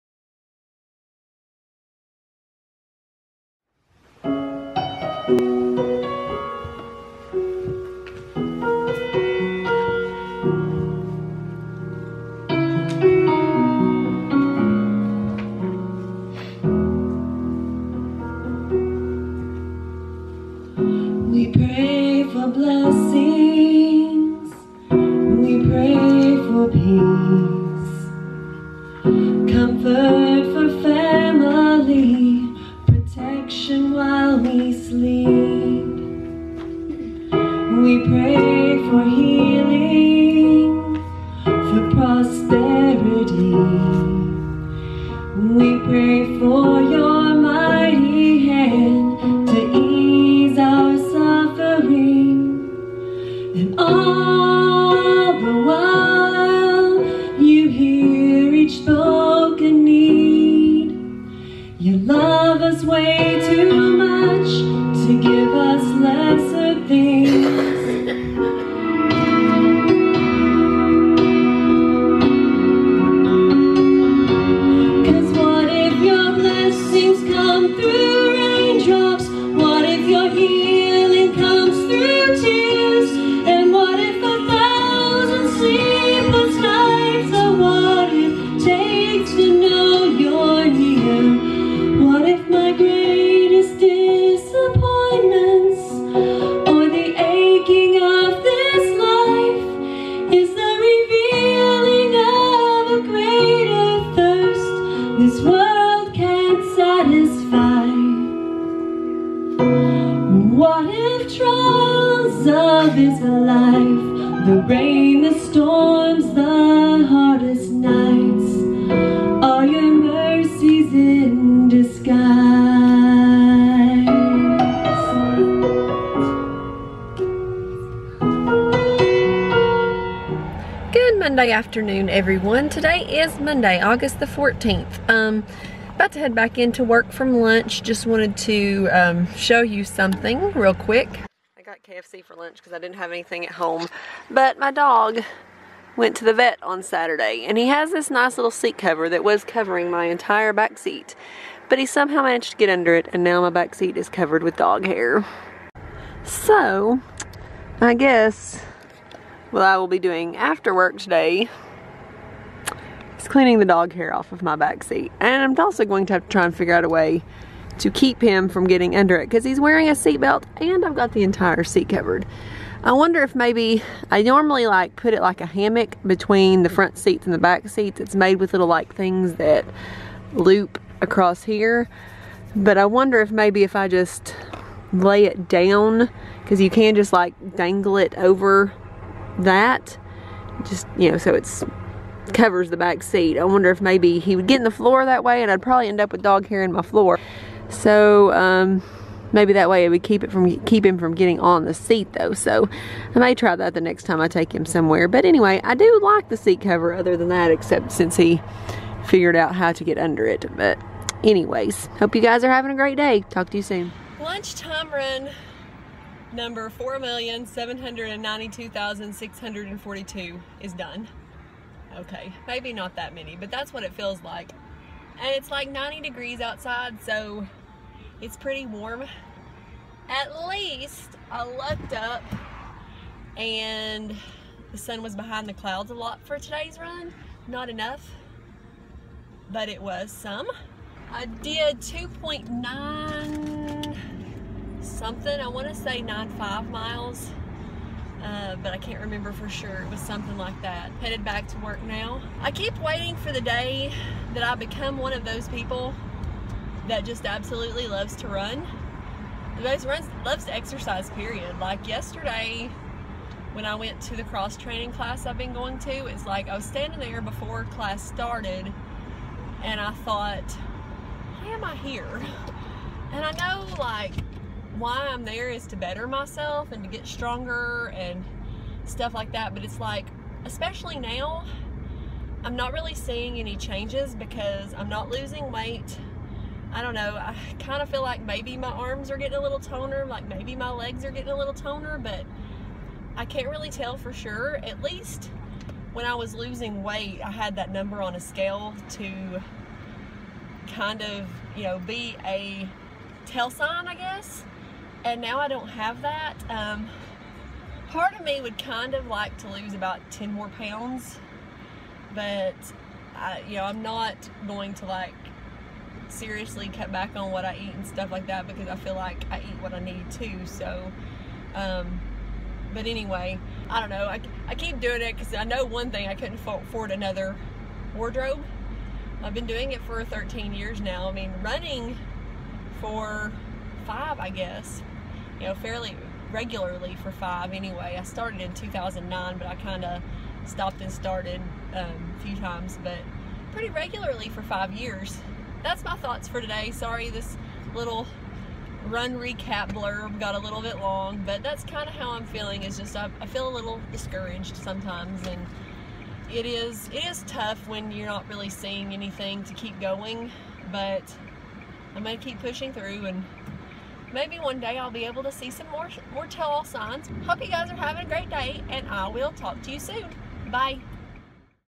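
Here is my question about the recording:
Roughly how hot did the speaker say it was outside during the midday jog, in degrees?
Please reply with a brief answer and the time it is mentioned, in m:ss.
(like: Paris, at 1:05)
90, at 3:45.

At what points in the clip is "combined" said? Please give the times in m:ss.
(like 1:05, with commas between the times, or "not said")
not said.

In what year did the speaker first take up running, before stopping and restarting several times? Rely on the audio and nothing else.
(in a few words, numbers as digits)
2009.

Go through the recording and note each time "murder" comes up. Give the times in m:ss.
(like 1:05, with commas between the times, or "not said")
not said.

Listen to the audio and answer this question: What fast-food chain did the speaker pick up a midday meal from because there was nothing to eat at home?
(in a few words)
KFC.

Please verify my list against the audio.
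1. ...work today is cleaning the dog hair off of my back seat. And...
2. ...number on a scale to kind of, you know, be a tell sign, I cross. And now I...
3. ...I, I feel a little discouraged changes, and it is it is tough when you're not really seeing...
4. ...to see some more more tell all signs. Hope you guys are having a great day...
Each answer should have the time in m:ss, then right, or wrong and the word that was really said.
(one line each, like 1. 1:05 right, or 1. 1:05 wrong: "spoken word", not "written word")
1. 2:40 right
2. 4:57 wrong: "guess", not "cross"
3. 5:52 wrong: "sometimes", not "changes"
4. 6:05 right.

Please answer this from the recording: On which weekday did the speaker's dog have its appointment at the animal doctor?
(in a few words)
Saturday.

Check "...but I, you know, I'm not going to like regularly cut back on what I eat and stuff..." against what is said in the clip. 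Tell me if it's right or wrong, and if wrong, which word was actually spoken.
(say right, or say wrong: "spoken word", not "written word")
wrong: "seriously", not "regularly".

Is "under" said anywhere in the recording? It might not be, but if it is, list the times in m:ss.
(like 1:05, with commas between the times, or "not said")
2:32, 2:48, 3:29.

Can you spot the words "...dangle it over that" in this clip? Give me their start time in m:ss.
3:07.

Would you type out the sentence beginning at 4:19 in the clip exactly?
Those runs loves to exercise, period.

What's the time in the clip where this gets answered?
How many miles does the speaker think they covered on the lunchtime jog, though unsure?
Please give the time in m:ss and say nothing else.
4:06.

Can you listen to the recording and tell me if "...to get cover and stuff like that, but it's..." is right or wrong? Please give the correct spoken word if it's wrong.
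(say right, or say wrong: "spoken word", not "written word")
wrong: "stronger", not "cover".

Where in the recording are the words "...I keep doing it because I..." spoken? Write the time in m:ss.
5:24.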